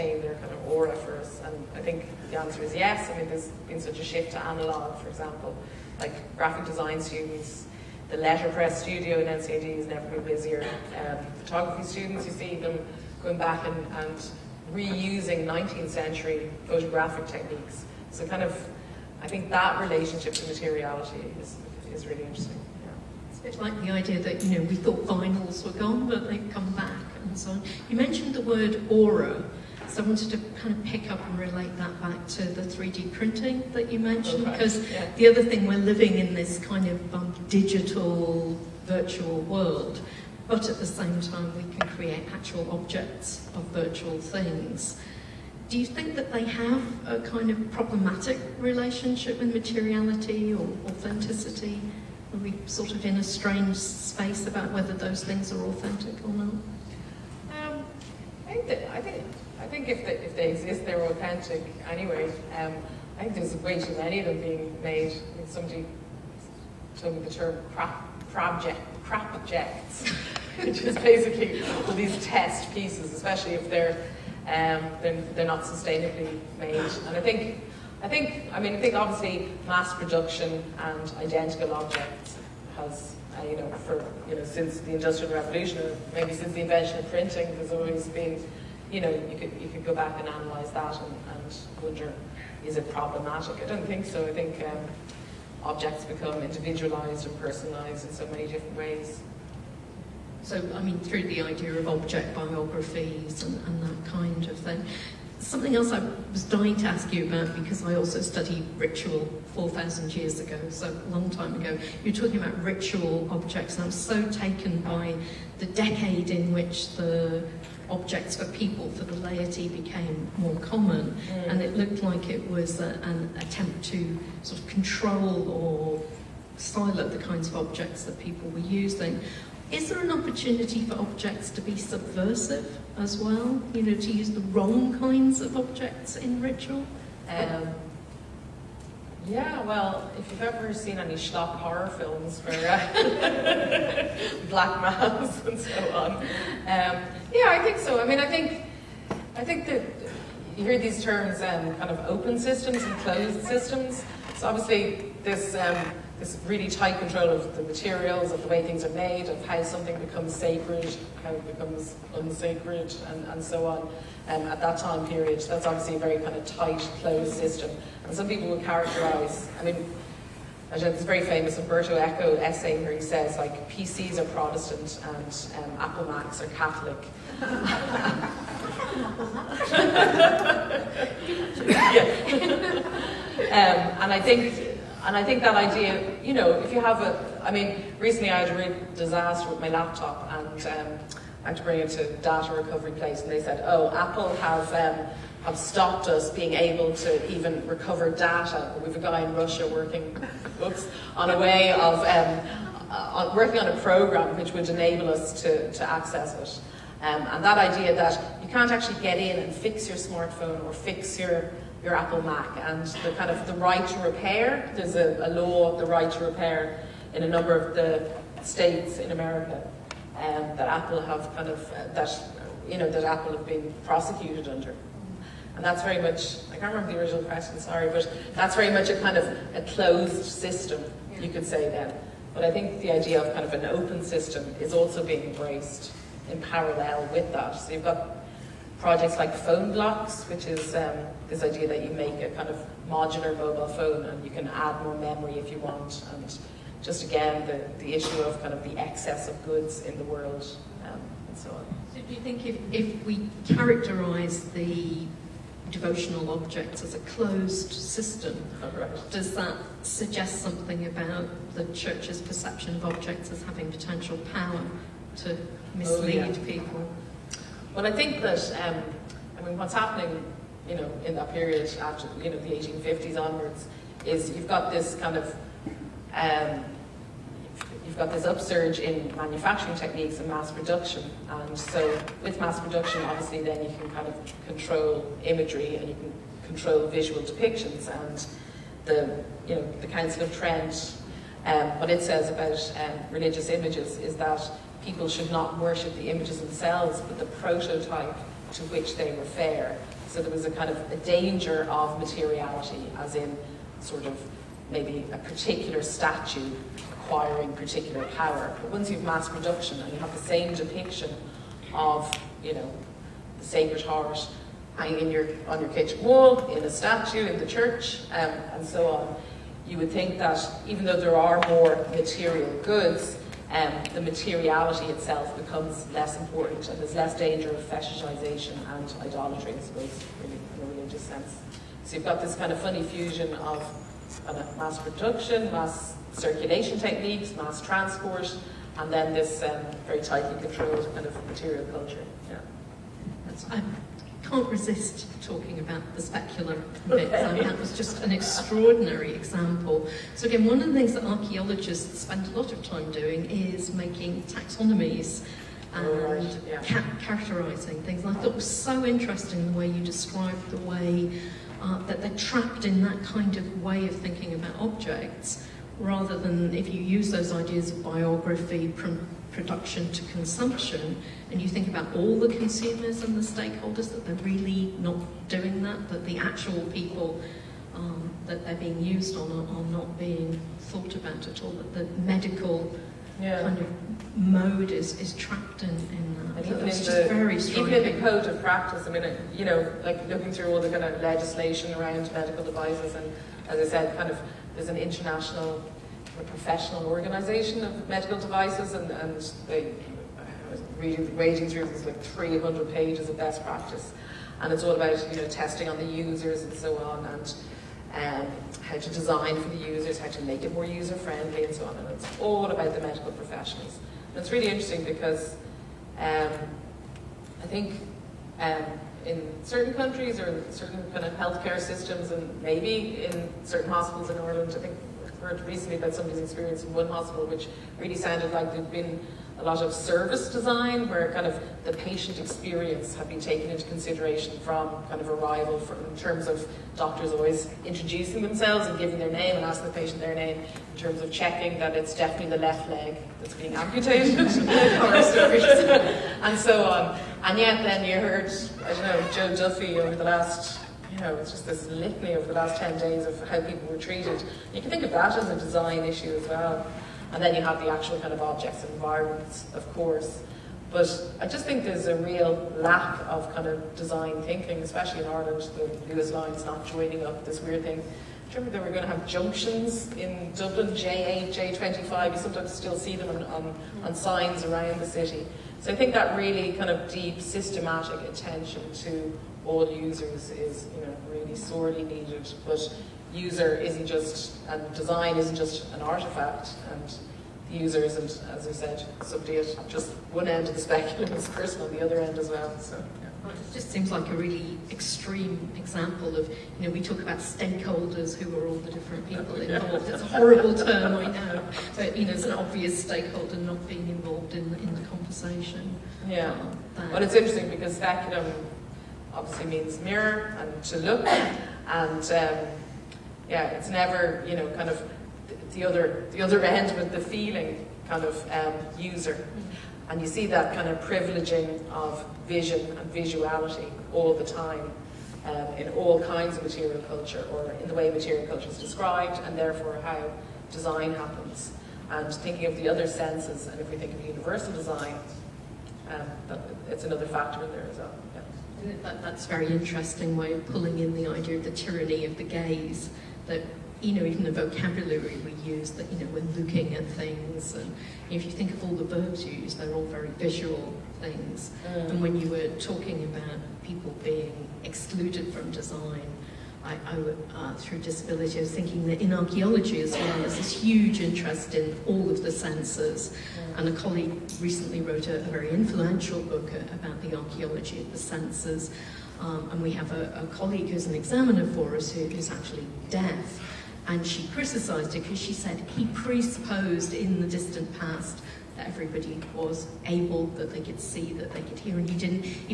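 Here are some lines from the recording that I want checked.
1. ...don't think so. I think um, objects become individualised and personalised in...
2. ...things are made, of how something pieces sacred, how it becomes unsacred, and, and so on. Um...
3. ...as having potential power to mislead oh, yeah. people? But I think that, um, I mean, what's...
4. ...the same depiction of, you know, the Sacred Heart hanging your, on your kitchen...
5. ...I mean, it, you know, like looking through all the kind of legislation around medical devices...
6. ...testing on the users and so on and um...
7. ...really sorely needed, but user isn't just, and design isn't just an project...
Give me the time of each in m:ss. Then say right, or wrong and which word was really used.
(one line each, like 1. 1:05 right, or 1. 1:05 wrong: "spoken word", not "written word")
1. 1:33 right
2. 2:38 wrong: "becomes", not "pieces"
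3. 4:23 right
4. 5:10 right
5. 6:28 right
6. 6:45 right
7. 8:01 wrong: "artifact", not "project".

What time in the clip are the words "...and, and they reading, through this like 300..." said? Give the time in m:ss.
6:38.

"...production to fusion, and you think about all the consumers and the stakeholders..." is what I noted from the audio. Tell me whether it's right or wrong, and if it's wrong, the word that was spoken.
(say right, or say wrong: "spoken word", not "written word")
wrong: "consumption", not "fusion".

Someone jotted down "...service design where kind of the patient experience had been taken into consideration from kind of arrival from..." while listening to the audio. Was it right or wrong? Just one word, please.
right.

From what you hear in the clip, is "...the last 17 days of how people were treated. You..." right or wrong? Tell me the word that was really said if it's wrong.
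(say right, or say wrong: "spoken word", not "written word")
wrong: "10", not "17".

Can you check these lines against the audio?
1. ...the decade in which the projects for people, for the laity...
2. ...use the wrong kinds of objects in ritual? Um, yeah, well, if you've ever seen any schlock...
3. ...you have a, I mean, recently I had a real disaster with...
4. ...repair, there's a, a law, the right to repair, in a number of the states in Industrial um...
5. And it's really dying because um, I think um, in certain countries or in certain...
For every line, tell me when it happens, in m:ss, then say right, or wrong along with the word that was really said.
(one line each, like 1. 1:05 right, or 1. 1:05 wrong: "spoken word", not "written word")
1. 1:55 wrong: "objects", not "projects"
2. 2:14 right
3. 3:06 right
4. 3:33 wrong: "America", not "Industrial"
5. 6:54 wrong: "interesting", not "dying".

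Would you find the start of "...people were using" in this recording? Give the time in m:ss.
2:08.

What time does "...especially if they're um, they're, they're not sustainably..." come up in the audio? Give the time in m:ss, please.
1:13.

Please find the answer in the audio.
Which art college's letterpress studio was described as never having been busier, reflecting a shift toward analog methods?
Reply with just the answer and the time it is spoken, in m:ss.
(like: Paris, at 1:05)
NCAD, at 0:09.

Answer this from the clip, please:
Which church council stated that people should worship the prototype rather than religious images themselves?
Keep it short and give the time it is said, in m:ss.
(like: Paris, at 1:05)
Council of Trent, at 4:49.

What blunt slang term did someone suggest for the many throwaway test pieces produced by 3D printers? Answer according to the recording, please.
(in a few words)
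crap objects.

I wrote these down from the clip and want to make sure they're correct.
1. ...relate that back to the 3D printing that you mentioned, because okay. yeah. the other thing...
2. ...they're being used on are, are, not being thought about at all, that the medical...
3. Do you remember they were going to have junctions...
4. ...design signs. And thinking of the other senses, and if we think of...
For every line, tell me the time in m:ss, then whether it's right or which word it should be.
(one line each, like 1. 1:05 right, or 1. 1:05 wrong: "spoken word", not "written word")
1. 0:31 right
2. 6:18 right
3. 7:47 right
4. 8:50 wrong: "happens", not "signs".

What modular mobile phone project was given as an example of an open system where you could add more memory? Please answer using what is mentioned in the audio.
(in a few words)
Phonebloks.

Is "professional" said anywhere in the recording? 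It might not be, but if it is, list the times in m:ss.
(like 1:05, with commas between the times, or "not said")
6:36, 6:53.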